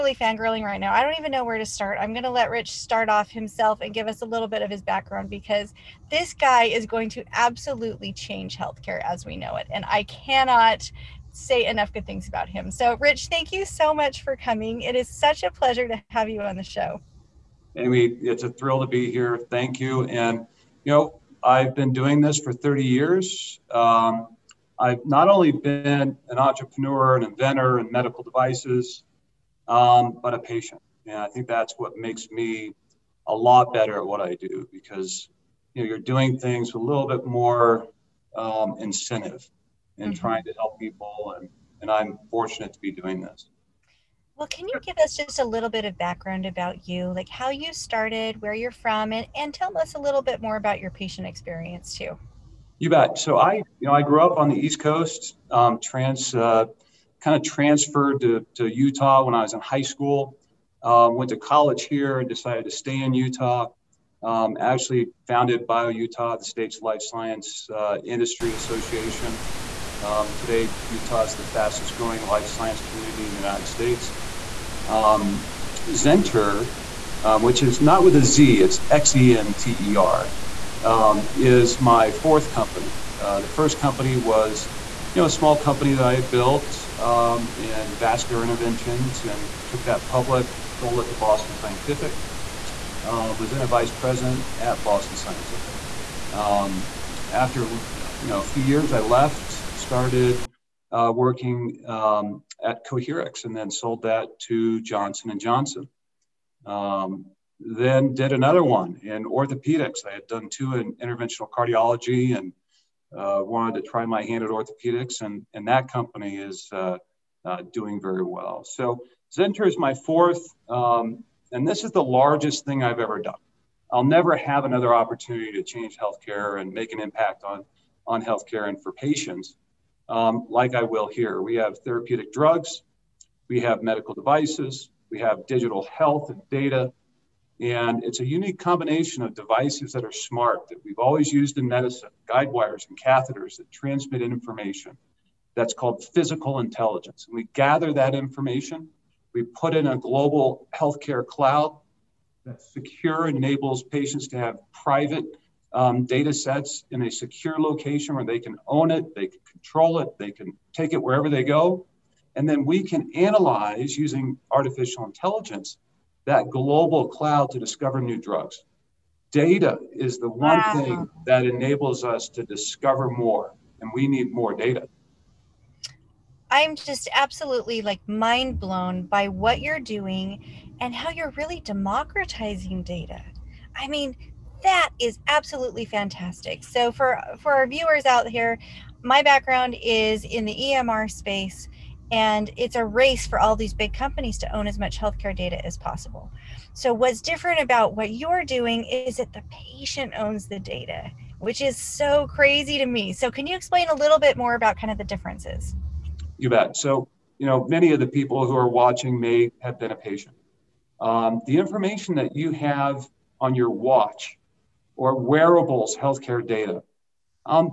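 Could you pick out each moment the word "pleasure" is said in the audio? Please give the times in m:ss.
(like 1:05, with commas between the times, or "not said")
0:15.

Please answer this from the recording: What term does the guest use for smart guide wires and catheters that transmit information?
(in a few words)
physical intelligence.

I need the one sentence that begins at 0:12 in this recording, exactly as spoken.
So, Rich, thank you so much for coming.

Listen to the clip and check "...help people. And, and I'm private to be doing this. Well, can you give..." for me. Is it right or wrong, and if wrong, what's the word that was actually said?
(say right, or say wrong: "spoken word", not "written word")
wrong: "fortunate", not "private".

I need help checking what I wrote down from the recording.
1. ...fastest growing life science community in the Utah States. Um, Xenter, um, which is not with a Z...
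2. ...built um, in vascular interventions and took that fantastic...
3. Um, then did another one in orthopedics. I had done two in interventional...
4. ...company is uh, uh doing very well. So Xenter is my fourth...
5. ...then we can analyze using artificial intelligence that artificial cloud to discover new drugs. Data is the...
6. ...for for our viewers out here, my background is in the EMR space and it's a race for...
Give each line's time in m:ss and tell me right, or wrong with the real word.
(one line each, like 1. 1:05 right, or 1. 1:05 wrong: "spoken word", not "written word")
1. 1:11 wrong: "United", not "Utah"
2. 1:26 wrong: "public", not "fantastic"
3. 1:46 right
4. 1:55 right
5. 2:42 wrong: "global", not "artificial"
6. 3:06 right.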